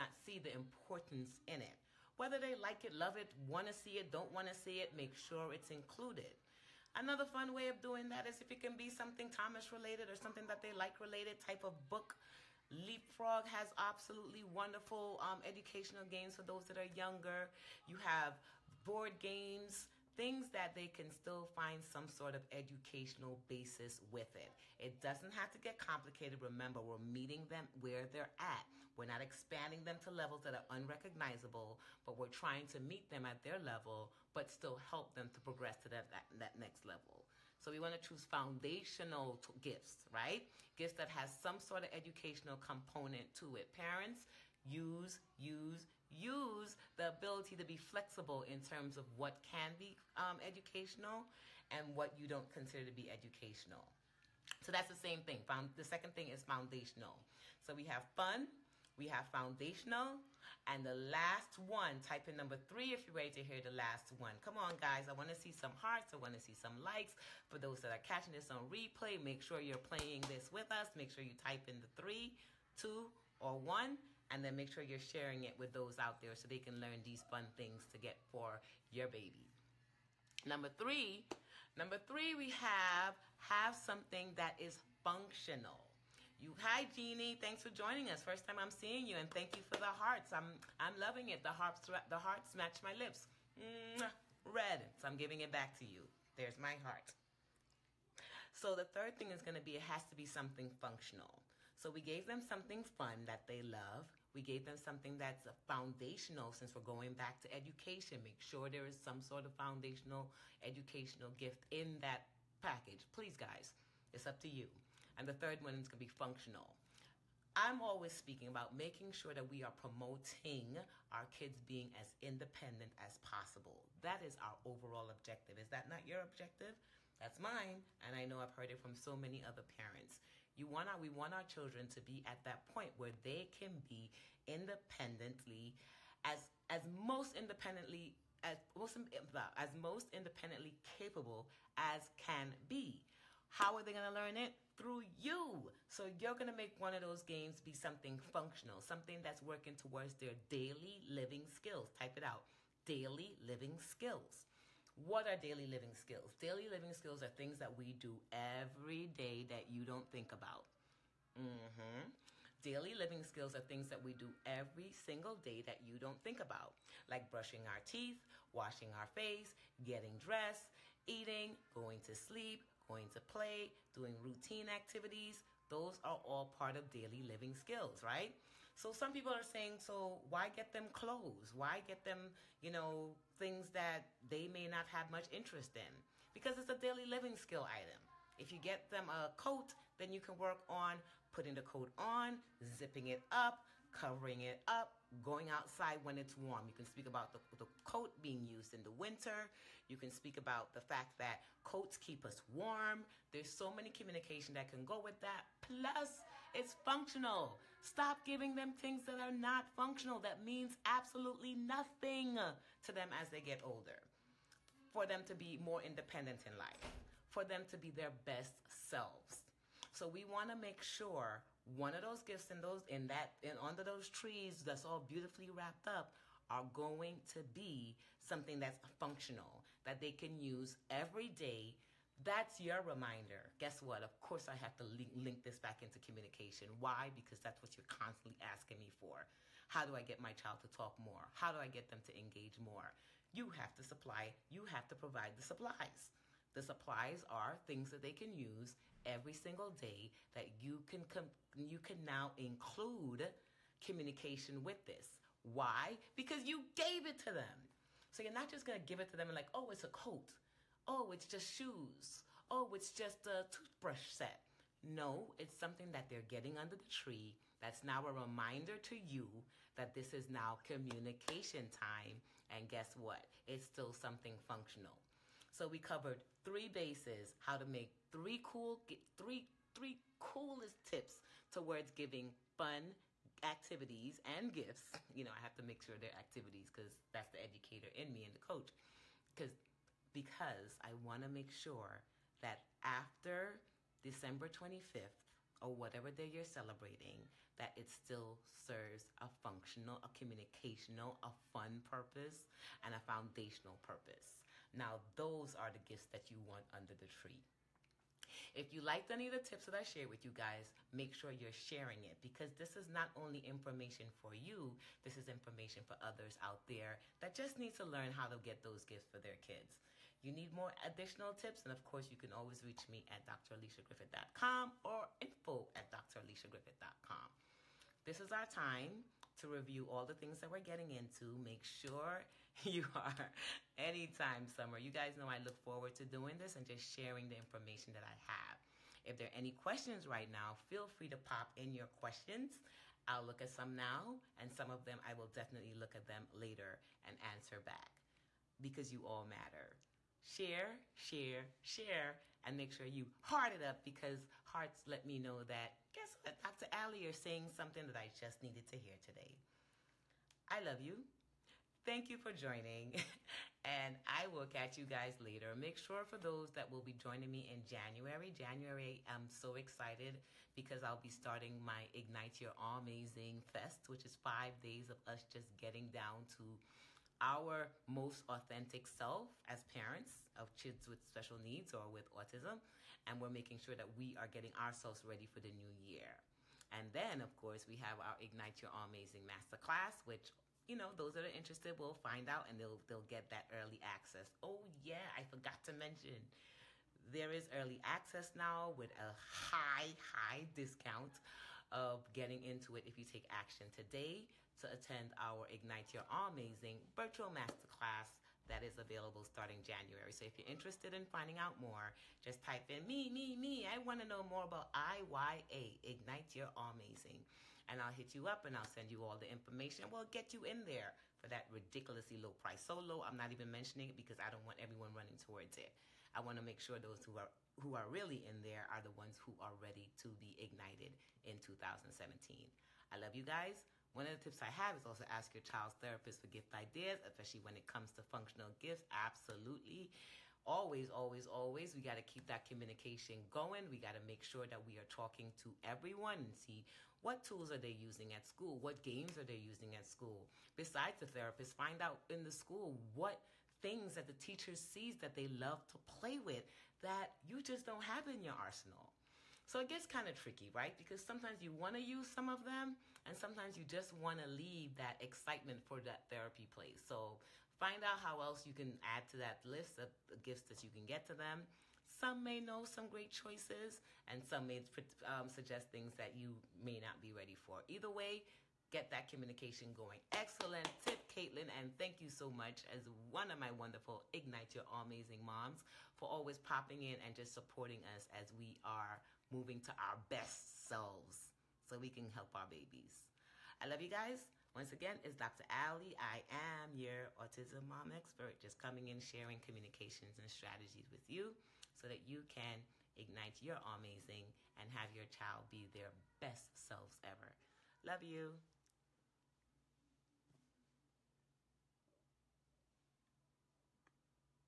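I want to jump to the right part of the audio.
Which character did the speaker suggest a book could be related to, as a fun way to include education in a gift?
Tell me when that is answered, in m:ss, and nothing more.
0:09.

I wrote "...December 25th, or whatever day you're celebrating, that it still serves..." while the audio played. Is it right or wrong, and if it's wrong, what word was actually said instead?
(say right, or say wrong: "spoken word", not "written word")
right.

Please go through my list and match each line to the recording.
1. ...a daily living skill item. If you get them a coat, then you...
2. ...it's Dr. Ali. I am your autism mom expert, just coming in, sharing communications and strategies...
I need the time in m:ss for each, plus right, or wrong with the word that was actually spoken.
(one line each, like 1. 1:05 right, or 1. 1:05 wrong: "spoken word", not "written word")
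1. 3:06 right
2. 8:15 right.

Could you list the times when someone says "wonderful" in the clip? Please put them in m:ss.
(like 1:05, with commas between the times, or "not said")
0:14, 8:03.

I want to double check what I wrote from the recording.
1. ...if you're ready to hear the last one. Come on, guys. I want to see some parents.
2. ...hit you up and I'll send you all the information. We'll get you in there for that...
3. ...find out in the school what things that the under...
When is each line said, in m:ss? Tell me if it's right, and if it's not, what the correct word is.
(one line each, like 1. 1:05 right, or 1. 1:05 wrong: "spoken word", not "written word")
1. 1:02 wrong: "hearts", not "parents"
2. 6:57 right
3. 7:31 wrong: "teacher", not "under".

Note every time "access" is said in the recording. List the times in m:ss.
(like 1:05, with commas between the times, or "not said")
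6:33, 6:37.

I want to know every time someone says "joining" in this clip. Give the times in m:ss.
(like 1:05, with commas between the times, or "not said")
1:27, 6:02, 6:06.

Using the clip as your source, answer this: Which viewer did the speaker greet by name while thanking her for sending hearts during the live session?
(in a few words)
Jeannie.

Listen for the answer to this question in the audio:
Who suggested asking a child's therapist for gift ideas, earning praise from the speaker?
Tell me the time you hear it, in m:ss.
8:01.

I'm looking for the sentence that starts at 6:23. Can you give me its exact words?
And we're making sure that we are getting ourselves ready for the new year.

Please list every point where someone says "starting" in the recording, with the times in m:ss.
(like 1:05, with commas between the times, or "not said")
6:11, 6:49.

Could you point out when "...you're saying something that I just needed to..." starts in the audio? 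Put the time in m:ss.
5:57.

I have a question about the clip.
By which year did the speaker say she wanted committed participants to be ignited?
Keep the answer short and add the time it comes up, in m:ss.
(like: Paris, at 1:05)
2017, at 7:11.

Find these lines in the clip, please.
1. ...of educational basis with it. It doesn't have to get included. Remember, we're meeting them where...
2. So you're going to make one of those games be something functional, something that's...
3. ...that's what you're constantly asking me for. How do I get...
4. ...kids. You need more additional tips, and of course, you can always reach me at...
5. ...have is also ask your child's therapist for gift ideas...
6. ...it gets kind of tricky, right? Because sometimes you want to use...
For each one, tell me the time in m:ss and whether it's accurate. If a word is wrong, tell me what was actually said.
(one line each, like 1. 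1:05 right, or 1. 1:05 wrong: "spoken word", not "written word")
1. 0:22 wrong: "complicated", not "included"
2. 2:25 right
3. 3:57 right
4. 5:19 right
5. 7:14 right
6. 7:39 right.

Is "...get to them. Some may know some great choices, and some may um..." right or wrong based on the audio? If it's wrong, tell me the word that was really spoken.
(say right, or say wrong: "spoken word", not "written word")
right.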